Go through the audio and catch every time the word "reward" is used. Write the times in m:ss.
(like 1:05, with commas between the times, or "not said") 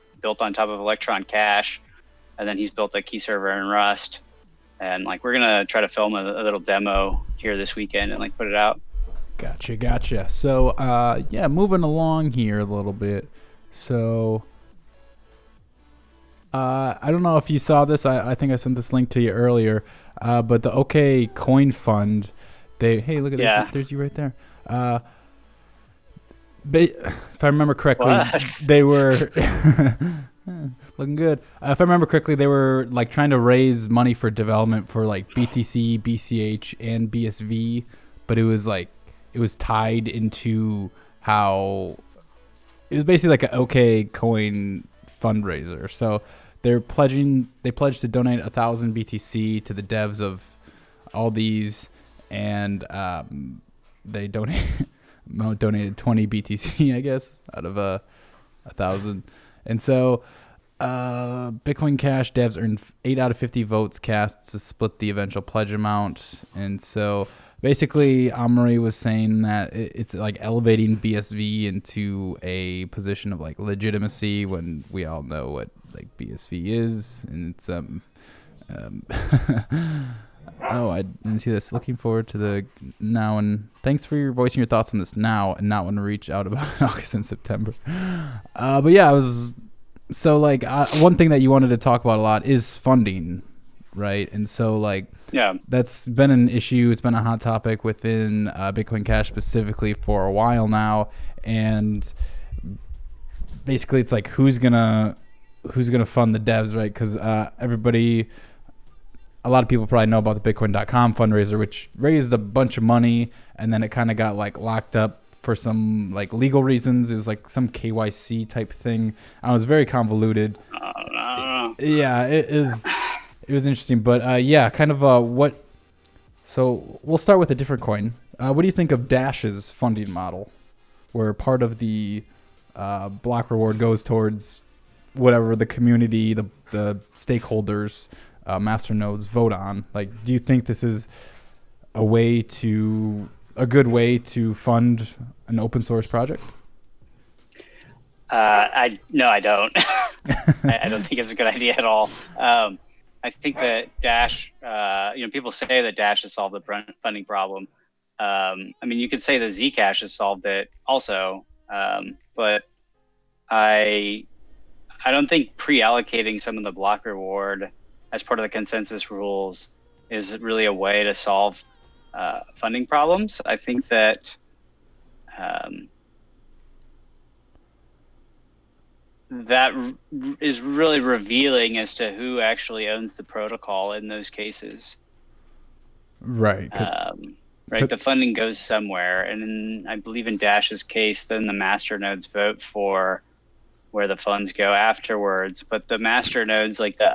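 2:13, 2:47.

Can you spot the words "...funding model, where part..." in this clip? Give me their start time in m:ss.
2:09.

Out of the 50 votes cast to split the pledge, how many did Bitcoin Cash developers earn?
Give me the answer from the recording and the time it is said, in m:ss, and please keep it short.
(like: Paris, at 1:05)
8, at 1:03.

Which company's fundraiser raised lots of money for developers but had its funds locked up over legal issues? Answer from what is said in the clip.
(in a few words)
Bitcoin.com.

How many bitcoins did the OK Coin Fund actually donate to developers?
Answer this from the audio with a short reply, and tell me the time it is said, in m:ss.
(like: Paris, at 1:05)
20 BTC, at 0:55.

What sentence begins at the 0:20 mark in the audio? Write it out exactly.
Uh, but the OK Coin Fund, they hey, look at yeah.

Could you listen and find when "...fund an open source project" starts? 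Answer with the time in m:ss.
2:24.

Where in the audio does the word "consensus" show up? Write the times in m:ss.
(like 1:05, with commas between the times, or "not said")
2:48.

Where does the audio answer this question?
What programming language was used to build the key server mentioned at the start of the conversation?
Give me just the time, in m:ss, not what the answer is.
0:03.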